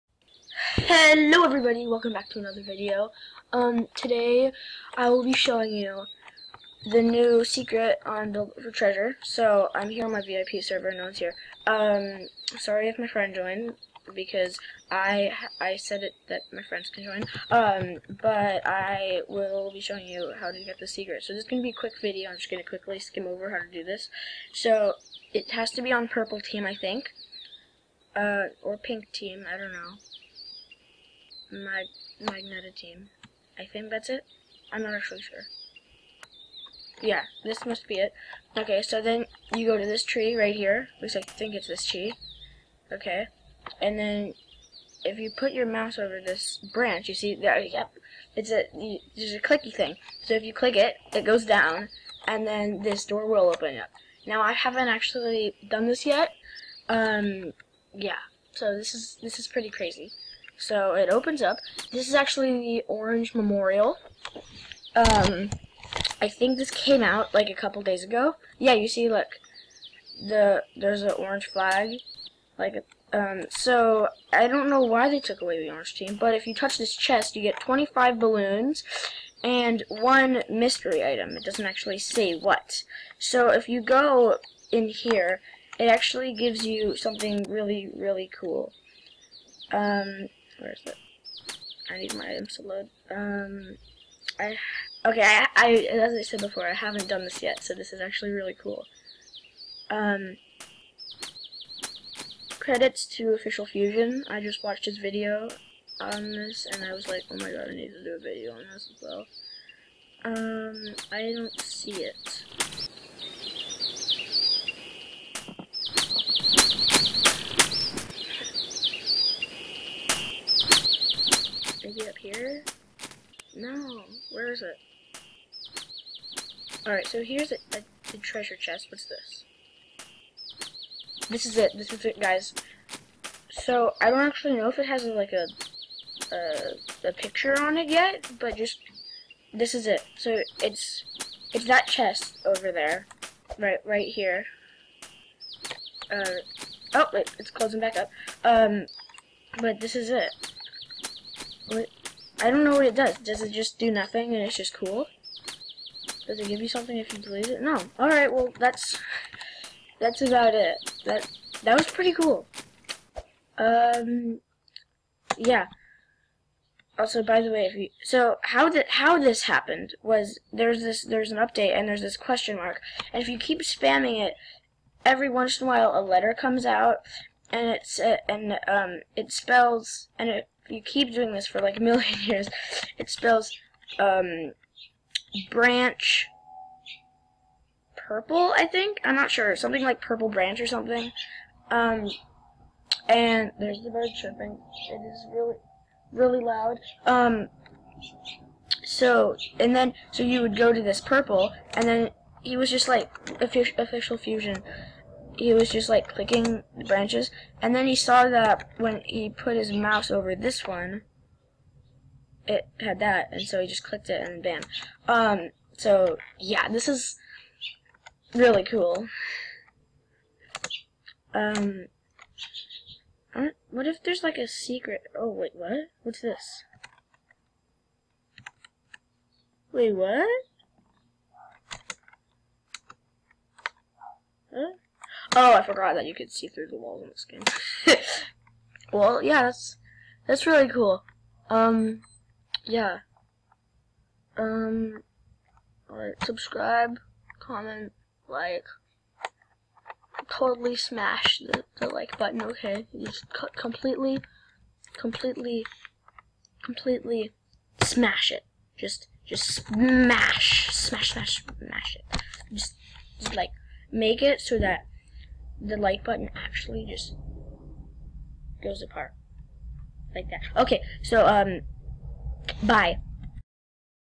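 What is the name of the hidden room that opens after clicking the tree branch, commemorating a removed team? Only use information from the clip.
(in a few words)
Orange Memorial.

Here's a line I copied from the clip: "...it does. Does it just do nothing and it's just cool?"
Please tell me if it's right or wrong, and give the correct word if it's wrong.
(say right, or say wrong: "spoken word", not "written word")
right.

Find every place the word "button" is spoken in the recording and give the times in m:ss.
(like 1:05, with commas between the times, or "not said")
4:12, 4:26.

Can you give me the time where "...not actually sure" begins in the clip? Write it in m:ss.
0:34.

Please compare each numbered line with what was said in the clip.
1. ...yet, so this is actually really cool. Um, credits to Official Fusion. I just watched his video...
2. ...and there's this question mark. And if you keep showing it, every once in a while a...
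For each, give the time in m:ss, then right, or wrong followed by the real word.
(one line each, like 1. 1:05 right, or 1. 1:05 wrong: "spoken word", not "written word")
1. 1:37 right
2. 2:51 wrong: "spamming", not "showing".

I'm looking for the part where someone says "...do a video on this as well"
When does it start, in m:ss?
1:48.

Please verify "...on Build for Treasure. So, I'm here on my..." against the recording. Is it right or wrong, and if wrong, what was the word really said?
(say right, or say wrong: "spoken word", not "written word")
right.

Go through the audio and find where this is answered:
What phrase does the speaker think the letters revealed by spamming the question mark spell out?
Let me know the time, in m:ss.
3:05.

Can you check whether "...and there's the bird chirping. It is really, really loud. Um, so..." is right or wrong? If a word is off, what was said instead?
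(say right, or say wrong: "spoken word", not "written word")
right.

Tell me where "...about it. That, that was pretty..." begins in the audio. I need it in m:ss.
2:40.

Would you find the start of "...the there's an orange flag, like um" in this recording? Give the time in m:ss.
1:10.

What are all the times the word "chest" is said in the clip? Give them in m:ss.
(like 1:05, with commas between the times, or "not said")
1:16, 2:08, 2:21.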